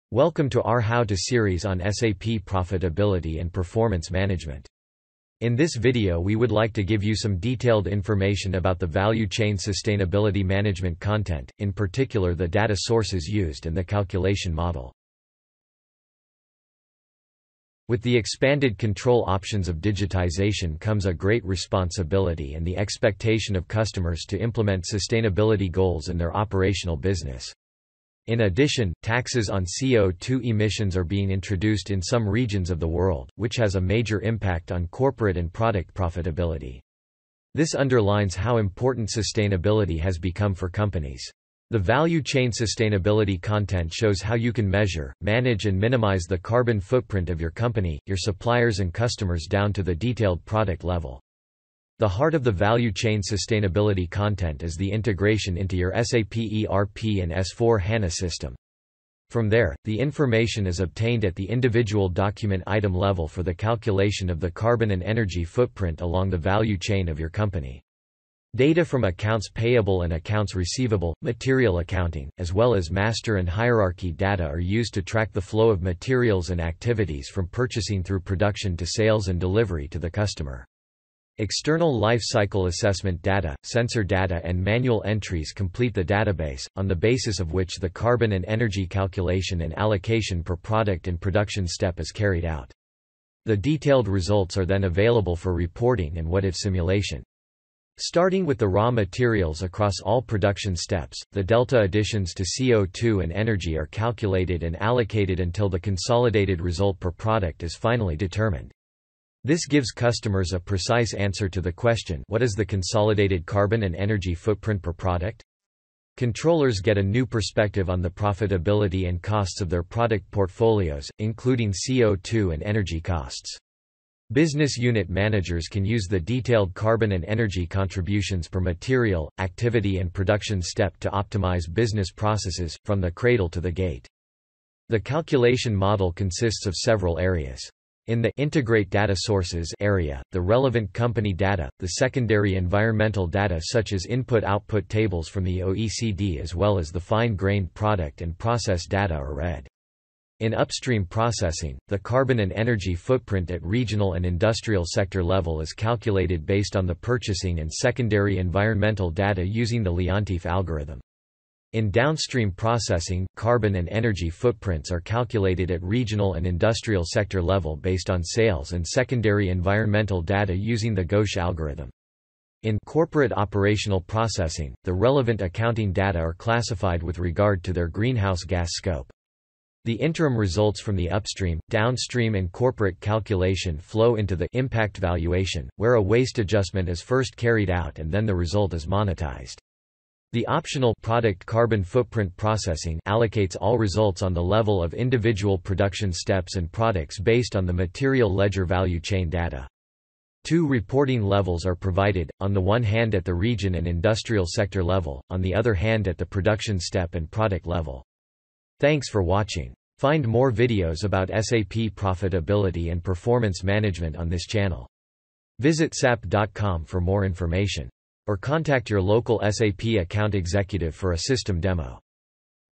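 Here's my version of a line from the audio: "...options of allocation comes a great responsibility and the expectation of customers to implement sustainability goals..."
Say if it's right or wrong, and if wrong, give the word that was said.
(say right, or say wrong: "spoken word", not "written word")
wrong: "digitization", not "allocation".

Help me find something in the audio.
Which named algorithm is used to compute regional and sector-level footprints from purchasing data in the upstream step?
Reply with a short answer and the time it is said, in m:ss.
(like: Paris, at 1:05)
Leontief algorithm, at 2:39.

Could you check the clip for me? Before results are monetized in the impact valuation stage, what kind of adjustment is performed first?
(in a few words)
Waste adjustment.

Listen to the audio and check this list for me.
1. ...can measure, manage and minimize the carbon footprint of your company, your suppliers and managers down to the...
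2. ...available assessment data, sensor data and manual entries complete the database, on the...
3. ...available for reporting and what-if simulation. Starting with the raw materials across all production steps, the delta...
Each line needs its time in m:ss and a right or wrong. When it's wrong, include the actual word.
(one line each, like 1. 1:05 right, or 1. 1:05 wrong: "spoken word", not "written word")
1. 0:44 wrong: "customers", not "managers"
2. 1:22 wrong: "cycle", not "available"
3. 1:34 right.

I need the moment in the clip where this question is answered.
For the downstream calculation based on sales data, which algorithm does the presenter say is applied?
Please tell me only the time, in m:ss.
2:51.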